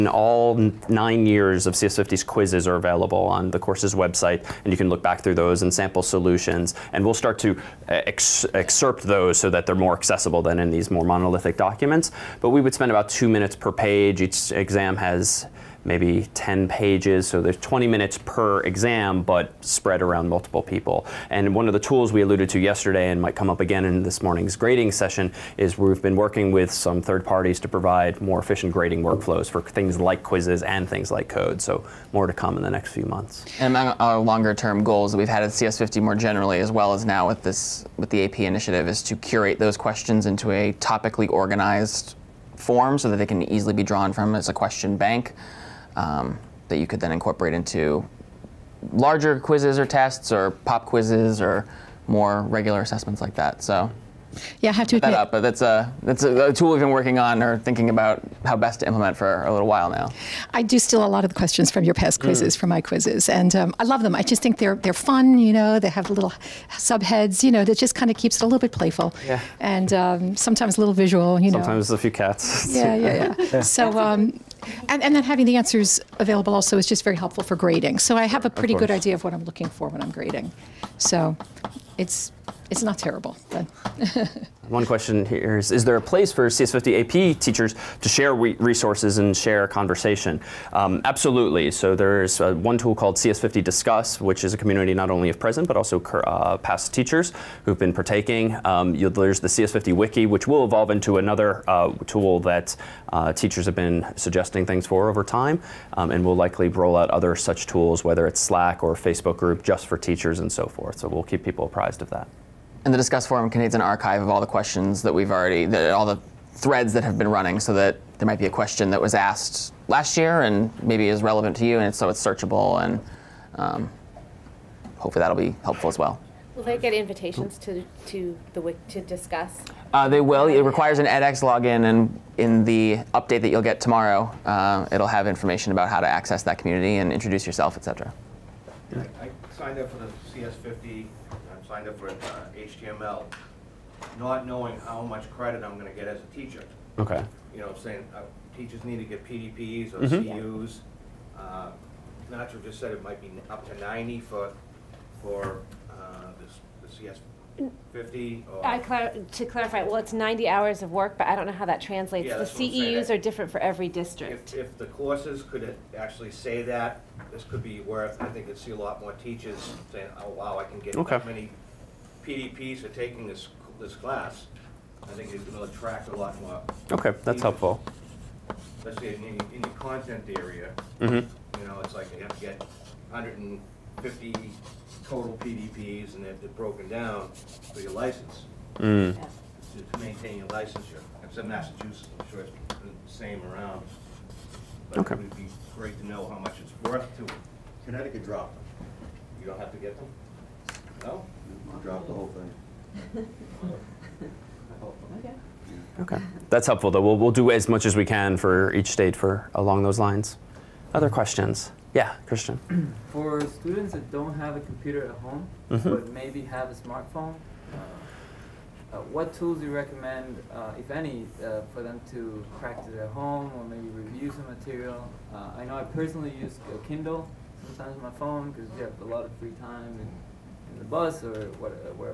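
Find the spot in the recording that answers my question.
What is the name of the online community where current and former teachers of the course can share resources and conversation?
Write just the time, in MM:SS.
01:33.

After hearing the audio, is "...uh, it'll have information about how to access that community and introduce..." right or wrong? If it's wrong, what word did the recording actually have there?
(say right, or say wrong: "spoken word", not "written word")
right.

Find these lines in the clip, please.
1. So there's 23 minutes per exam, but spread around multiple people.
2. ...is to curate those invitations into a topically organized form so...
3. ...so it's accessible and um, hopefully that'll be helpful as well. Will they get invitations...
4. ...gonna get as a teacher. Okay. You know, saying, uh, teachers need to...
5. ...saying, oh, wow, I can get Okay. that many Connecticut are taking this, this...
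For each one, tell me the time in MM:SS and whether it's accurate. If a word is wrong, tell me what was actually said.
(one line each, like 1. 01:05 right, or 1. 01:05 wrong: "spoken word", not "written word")
1. 00:17 wrong: "20", not "23"
2. 00:38 wrong: "questions", not "invitations"
3. 02:01 wrong: "searchable", not "accessible"
4. 02:25 right
5. 02:49 wrong: "PDPs", not "Connecticut".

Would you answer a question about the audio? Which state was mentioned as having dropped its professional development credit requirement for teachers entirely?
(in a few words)
Connecticut.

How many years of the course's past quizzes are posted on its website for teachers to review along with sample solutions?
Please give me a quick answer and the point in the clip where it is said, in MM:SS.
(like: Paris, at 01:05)
9, at 00:00.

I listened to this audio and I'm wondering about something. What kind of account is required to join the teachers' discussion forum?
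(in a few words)
edX login.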